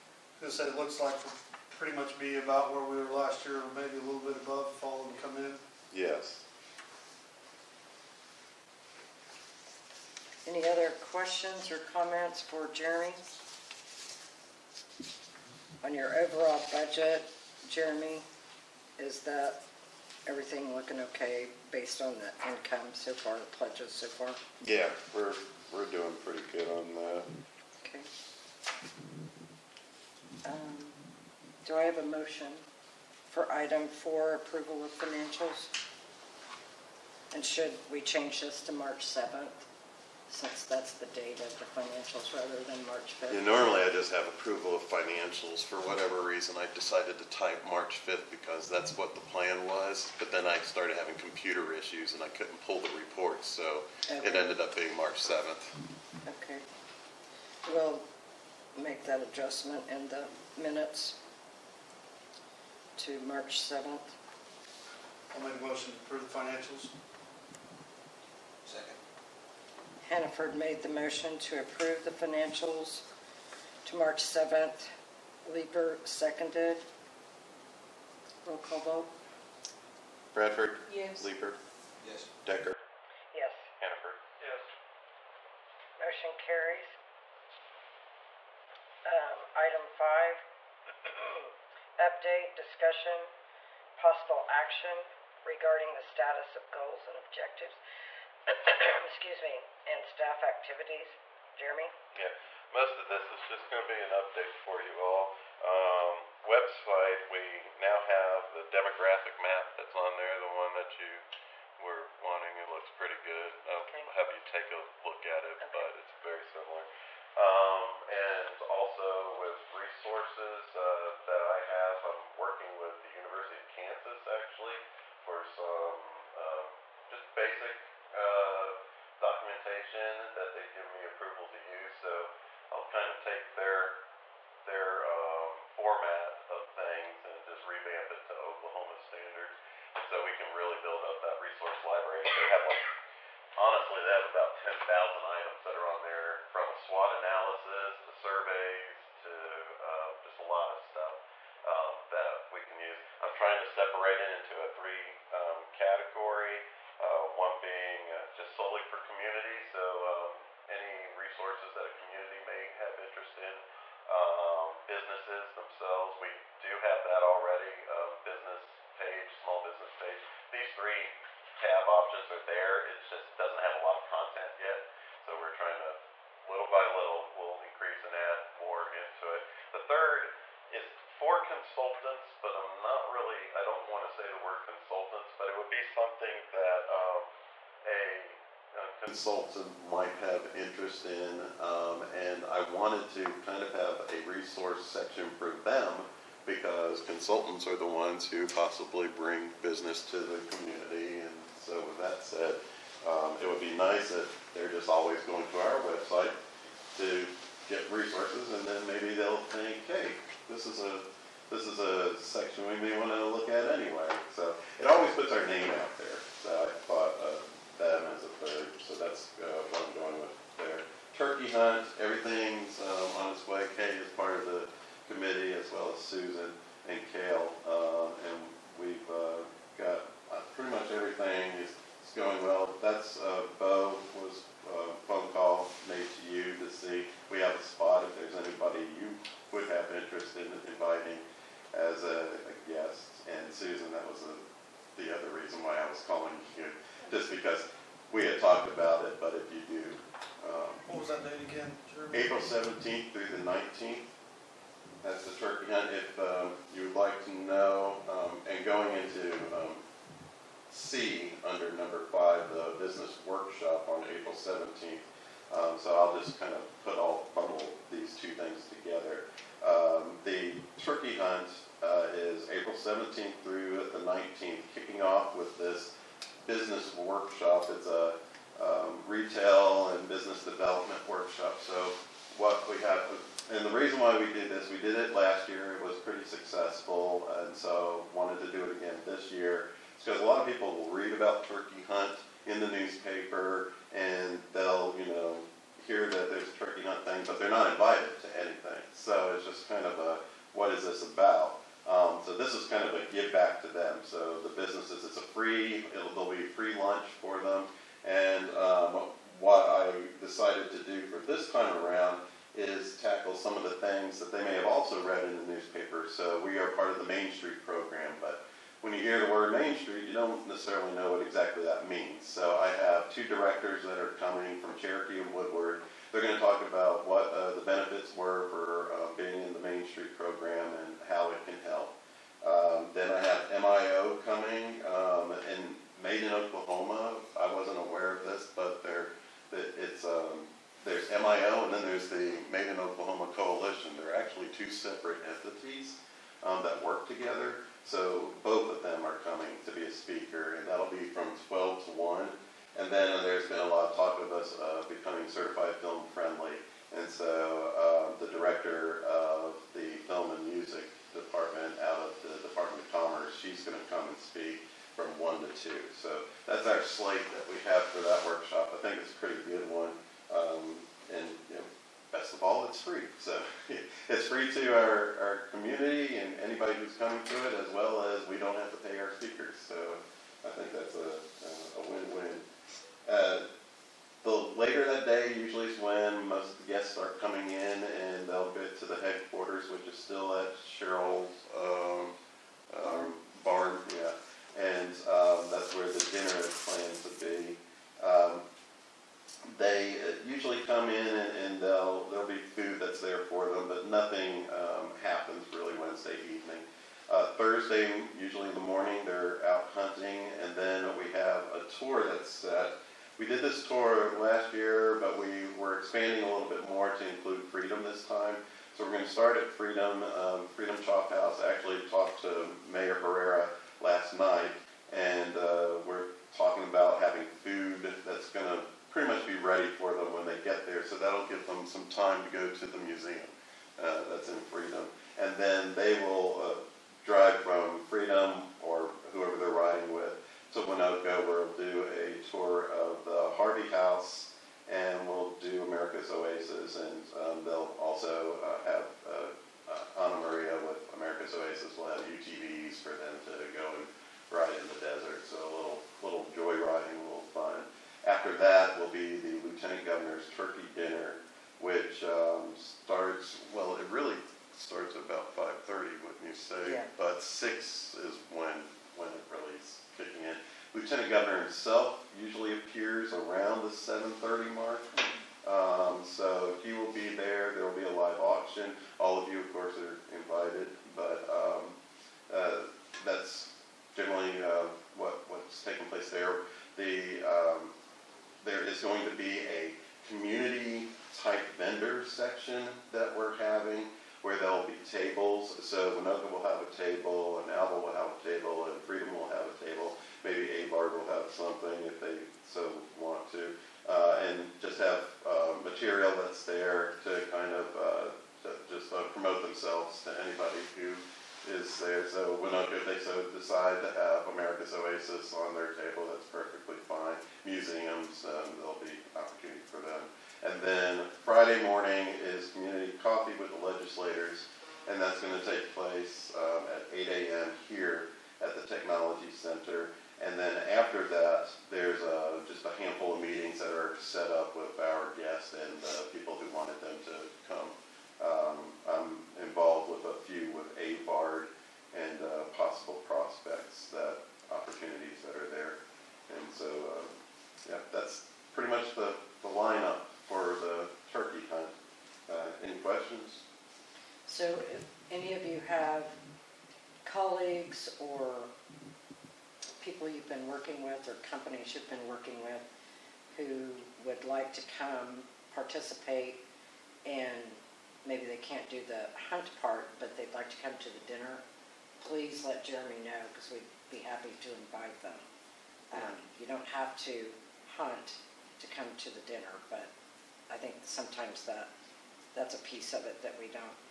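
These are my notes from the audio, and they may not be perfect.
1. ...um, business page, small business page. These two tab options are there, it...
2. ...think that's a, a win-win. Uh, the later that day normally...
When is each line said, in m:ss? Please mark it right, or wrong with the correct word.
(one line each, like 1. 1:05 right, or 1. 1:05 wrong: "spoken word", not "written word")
1. 2:47 wrong: "three", not "two"
2. 6:20 wrong: "usually", not "normally".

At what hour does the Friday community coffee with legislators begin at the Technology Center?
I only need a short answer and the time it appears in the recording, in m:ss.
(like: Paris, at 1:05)
8 a.m., at 8:46.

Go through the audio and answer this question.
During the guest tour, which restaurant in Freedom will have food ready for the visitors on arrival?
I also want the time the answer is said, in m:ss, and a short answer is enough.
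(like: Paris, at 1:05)
Freedom Chop House, at 7:00.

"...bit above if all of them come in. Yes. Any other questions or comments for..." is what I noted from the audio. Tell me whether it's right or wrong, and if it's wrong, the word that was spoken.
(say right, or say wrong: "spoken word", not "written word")
right.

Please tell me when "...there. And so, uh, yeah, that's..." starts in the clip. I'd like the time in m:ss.
9:05.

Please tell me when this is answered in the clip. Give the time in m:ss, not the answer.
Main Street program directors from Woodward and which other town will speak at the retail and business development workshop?
5:24.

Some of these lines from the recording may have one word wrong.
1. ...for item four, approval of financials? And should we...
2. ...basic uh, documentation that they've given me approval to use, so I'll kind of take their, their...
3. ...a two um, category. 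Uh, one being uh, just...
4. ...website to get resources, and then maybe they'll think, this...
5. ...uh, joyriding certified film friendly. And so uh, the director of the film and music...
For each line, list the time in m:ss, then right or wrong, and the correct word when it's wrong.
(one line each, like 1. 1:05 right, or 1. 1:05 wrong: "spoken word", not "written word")
1. 0:33 right
2. 2:07 right
3. 2:34 wrong: "three", not "two"
4. 3:25 right
5. 5:54 wrong: "becoming", not "joyriding".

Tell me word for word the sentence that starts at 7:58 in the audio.
All of you, of course, are invited.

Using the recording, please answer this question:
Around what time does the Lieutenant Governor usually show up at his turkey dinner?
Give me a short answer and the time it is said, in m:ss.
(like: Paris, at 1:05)
7:30, at 7:53.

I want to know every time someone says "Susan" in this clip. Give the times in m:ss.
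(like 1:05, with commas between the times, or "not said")
3:46, 4:03.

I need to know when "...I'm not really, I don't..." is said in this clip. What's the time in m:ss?
3:02.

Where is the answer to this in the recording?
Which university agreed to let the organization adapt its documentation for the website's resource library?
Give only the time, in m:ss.
2:03.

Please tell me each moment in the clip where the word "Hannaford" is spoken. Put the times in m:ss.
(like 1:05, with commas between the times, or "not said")
1:10, 1:23.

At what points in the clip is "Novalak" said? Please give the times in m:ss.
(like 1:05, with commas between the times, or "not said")
not said.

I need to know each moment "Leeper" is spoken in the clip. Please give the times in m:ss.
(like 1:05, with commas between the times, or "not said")
1:15, 1:21.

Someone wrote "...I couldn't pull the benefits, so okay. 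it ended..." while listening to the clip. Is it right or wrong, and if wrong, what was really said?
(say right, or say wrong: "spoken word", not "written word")
wrong: "reports", not "benefits".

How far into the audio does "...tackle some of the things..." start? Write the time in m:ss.
5:13.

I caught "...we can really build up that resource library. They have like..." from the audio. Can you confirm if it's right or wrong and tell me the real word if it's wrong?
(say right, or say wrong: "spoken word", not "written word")
right.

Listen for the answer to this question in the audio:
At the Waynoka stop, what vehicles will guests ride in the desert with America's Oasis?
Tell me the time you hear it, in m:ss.
7:32.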